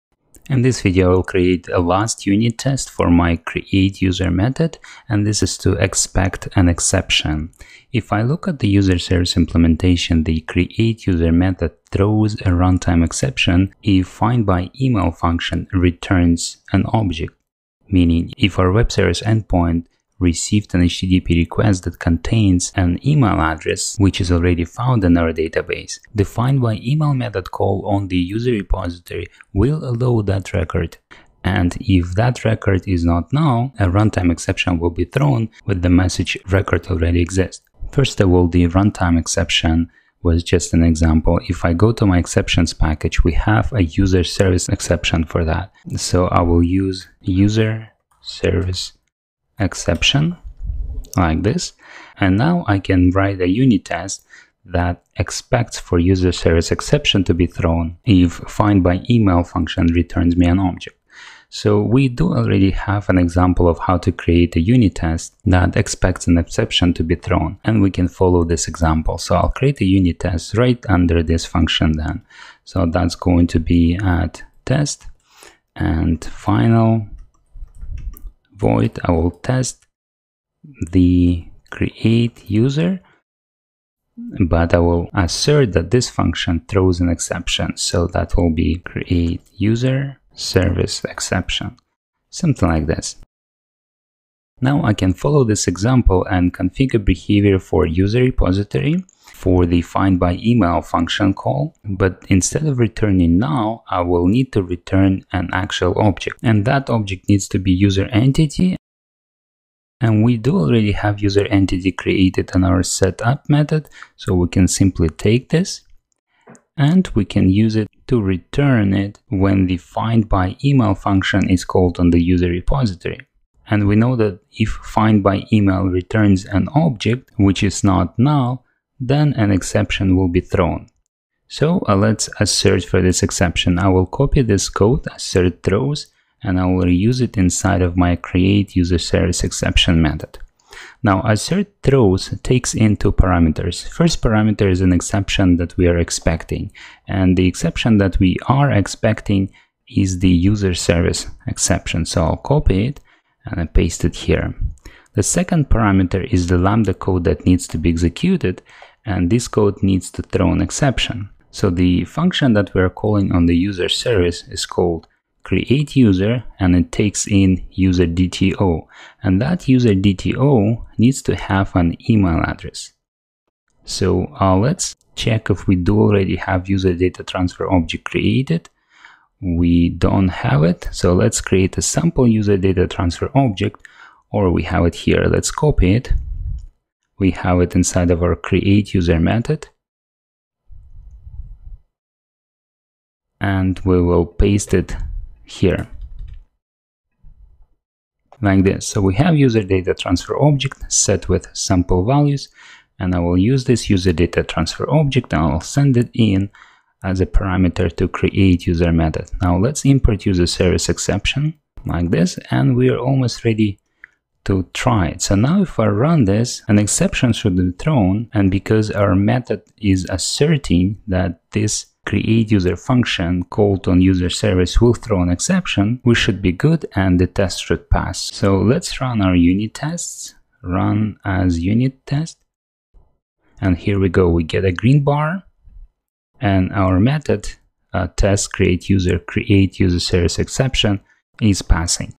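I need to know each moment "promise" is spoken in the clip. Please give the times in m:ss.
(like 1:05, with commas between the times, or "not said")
not said.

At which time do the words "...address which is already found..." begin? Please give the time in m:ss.
0:23.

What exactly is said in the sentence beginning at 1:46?
And that object needs to be user entity.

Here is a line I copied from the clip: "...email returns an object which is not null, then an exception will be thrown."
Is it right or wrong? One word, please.
right.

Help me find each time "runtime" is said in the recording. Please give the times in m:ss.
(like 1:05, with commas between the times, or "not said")
0:12, 0:33, 0:38.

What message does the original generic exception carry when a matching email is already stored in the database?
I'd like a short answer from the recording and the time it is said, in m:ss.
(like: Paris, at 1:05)
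record already exists, at 0:36.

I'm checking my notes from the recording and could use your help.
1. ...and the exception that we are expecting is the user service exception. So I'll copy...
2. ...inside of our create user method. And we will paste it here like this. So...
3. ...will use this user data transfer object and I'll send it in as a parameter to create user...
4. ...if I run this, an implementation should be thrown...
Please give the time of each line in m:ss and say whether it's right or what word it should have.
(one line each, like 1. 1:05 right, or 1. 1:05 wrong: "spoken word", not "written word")
1. 2:27 right
2. 3:07 right
3. 3:23 right
4. 3:35 wrong: "exception", not "implementation".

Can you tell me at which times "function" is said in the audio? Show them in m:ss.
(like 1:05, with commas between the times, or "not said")
0:15, 0:59, 1:11, 1:26, 1:40, 2:00, 2:42, 3:42.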